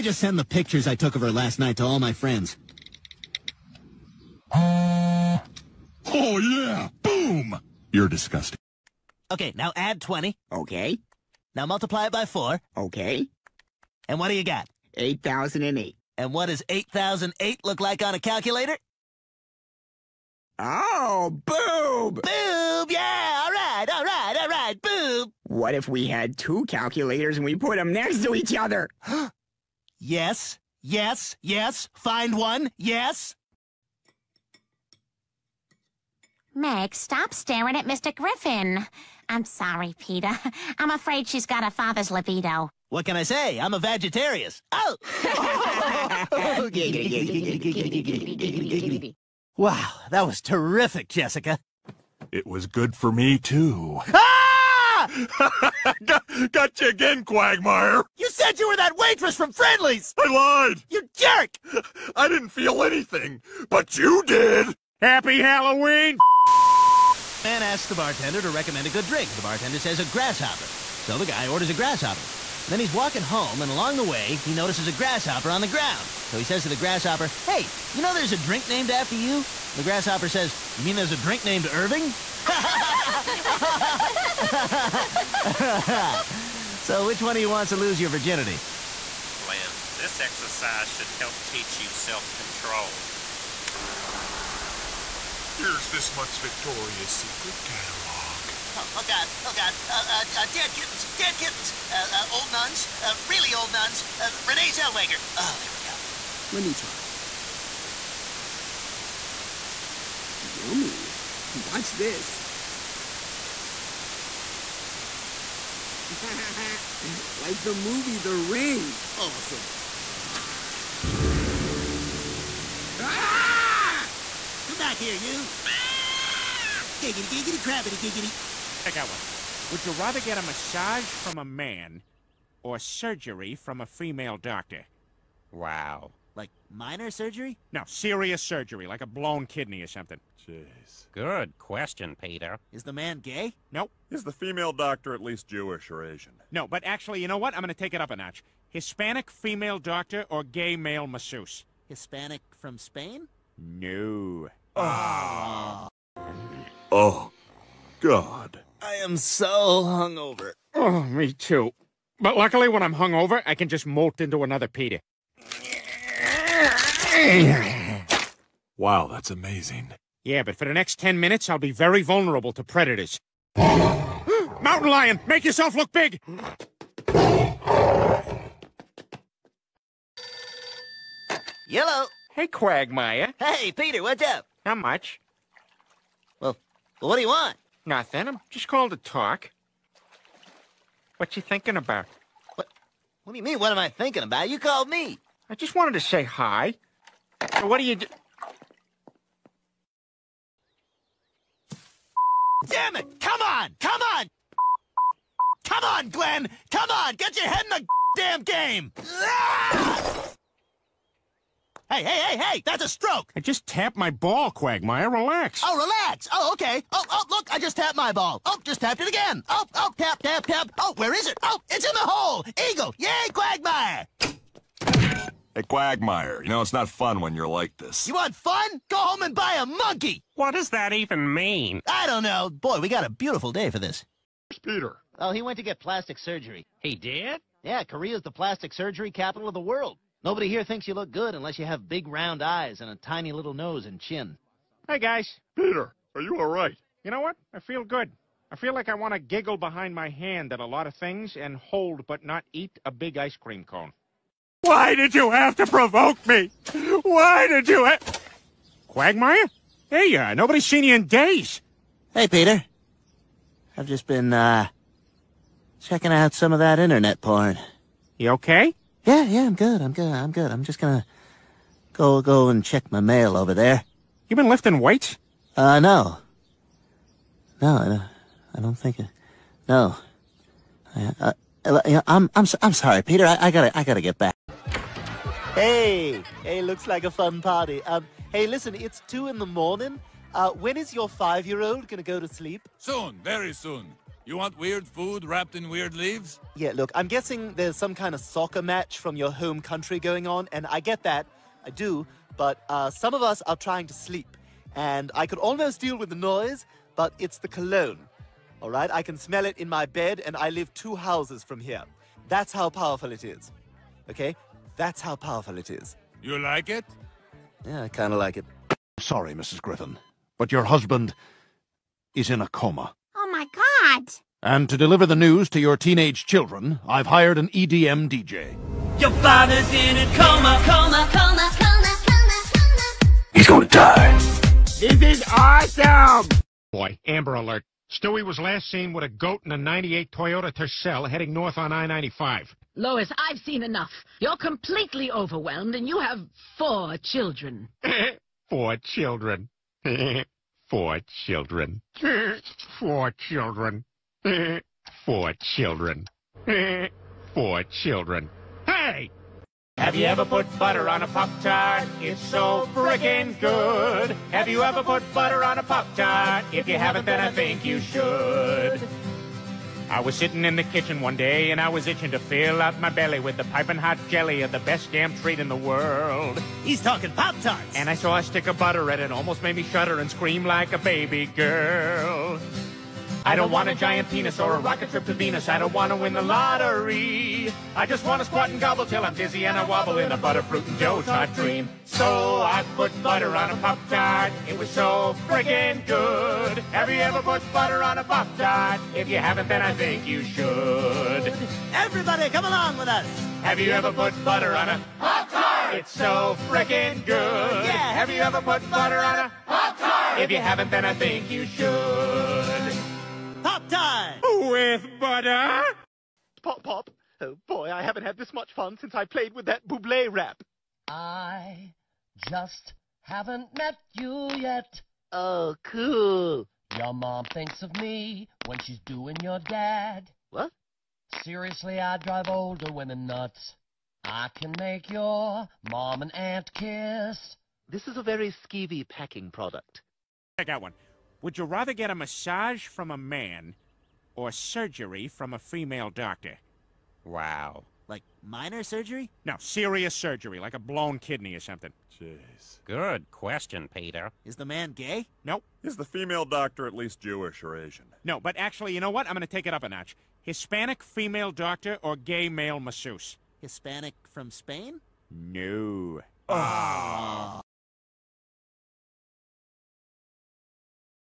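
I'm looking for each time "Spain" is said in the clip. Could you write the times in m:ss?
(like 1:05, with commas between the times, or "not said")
2:32, 7:44.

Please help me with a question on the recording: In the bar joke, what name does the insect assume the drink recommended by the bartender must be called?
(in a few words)
Irving.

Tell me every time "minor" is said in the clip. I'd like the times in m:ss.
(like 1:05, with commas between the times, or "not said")
2:16, 7:28.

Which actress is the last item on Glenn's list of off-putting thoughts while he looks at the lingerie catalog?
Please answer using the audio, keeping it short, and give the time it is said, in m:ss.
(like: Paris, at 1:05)
Renee Zellweger, at 1:44.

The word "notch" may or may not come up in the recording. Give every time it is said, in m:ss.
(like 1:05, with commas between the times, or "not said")
2:28, 7:39.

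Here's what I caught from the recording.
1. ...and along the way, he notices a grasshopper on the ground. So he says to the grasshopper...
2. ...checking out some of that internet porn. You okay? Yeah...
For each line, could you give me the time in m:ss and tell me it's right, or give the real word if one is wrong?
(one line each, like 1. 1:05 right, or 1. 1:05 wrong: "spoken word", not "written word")
1. 1:13 right
2. 4:25 right.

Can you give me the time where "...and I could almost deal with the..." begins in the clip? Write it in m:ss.
5:04.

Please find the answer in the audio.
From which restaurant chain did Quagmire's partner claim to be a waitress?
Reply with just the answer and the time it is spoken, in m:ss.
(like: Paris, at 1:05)
Friendly's, at 0:59.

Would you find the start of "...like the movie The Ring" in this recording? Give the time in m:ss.
1:57.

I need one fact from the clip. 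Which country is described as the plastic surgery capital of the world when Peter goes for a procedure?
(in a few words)
Korea.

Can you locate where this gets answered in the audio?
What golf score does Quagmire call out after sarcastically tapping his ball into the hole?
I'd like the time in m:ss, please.
3:42.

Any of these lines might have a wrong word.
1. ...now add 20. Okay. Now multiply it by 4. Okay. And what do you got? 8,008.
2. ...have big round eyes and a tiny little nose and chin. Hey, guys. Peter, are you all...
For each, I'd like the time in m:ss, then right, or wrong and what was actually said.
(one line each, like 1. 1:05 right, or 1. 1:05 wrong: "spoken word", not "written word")
1. 0:09 right
2. 4:01 right.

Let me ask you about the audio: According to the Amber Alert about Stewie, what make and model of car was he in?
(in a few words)
98 Toyota Tercel.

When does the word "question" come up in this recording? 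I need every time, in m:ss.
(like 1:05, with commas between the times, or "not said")
2:21, 7:33.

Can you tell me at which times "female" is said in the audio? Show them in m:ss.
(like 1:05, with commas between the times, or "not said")
2:13, 2:24, 2:29, 7:25, 7:35, 7:40.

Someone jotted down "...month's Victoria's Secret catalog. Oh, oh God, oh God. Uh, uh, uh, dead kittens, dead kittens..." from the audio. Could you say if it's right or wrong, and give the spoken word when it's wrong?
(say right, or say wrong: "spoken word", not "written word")
right.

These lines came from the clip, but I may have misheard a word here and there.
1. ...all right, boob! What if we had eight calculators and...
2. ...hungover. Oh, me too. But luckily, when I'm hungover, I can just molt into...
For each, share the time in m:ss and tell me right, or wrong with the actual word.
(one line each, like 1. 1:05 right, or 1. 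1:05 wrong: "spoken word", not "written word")
1. 0:24 wrong: "two", not "eight"
2. 2:39 right.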